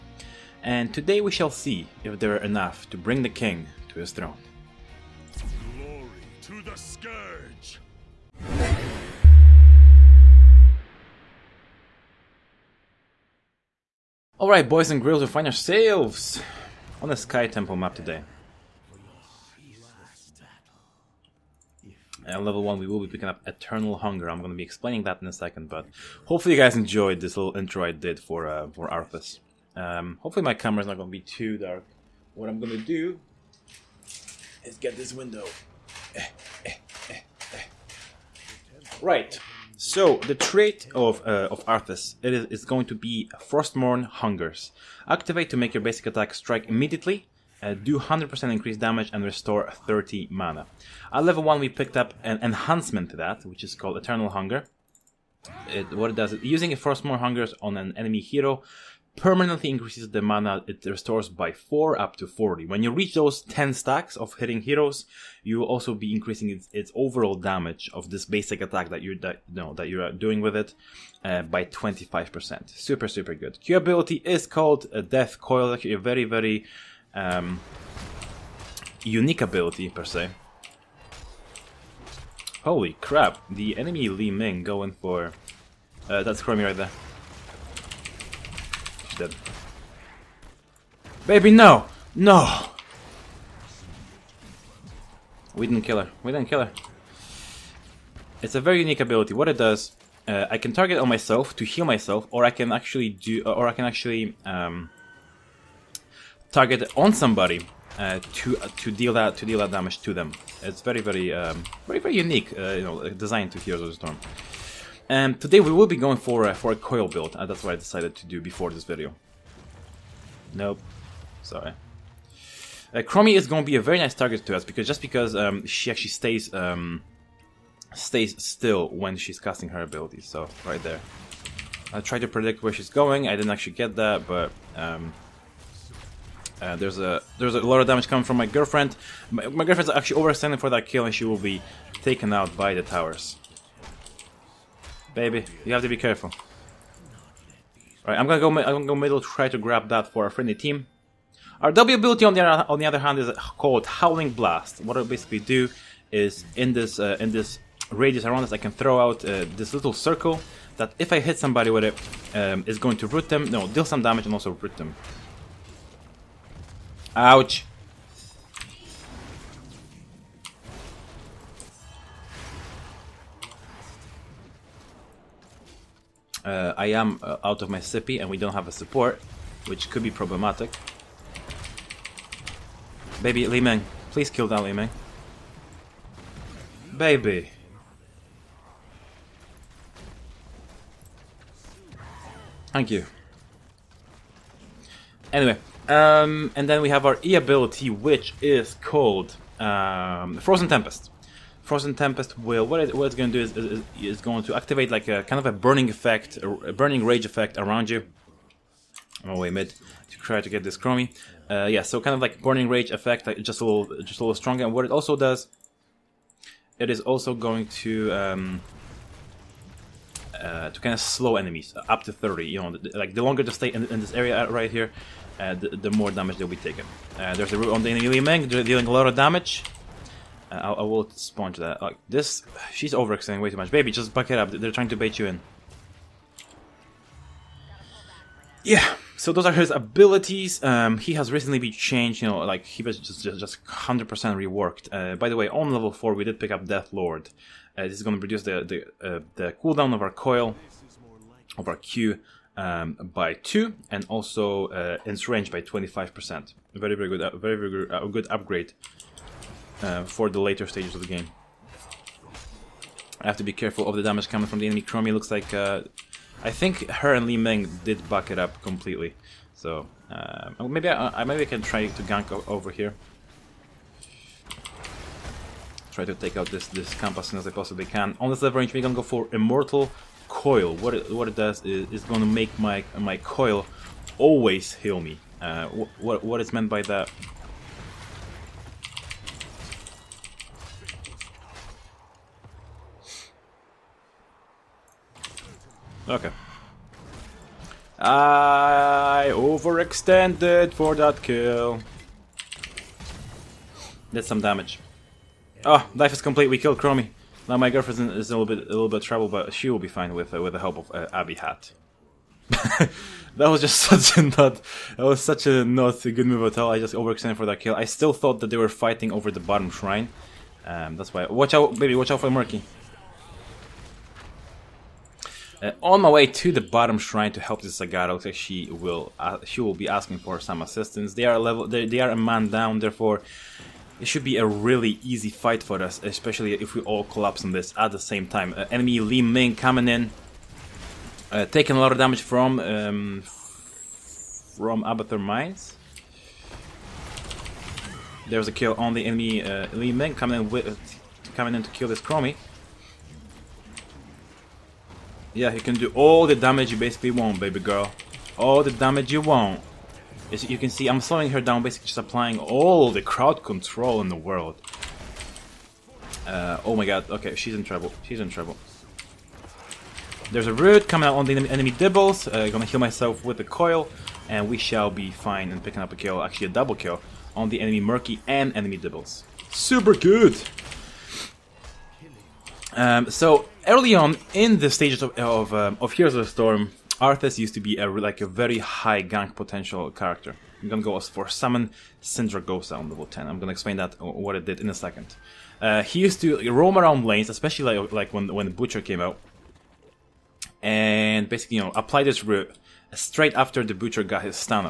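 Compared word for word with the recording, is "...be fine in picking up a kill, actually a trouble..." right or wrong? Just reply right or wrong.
wrong.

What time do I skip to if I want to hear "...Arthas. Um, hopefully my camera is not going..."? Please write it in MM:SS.
00:28.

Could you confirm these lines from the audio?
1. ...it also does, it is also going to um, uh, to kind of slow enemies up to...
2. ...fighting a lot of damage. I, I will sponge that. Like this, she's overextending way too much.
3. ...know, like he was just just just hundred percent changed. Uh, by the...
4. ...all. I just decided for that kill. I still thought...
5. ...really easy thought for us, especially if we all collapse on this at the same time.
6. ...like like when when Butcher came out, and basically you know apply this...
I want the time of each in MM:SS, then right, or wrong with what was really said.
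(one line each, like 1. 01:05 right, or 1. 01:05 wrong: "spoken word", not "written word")
1. 03:34 right
2. 03:48 wrong: "dealing", not "fighting"
3. 04:02 wrong: "reworked", not "changed"
4. 05:16 wrong: "overextended", not "decided"
5. 05:34 wrong: "fight", not "thought"
6. 06:37 right.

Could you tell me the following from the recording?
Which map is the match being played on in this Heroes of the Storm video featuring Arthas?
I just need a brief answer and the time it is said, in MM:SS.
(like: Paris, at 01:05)
Sky Temple, at 00:17.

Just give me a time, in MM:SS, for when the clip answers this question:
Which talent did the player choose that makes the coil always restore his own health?
04:39.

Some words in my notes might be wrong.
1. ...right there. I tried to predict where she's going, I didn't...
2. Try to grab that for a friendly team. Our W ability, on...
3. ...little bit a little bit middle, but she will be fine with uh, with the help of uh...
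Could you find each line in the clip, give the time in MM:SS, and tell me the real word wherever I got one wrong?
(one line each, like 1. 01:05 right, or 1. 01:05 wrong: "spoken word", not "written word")
1. 02:10 right
2. 02:29 right
3. 05:08 wrong: "trouble", not "middle".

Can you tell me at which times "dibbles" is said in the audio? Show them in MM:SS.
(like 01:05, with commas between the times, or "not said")
06:11, 06:18.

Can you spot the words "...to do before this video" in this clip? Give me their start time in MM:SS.
01:58.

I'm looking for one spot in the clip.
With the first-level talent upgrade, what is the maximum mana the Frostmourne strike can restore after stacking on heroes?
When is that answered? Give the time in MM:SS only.
01:01.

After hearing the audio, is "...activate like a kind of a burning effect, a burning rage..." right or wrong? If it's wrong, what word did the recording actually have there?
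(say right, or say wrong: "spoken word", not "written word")
right.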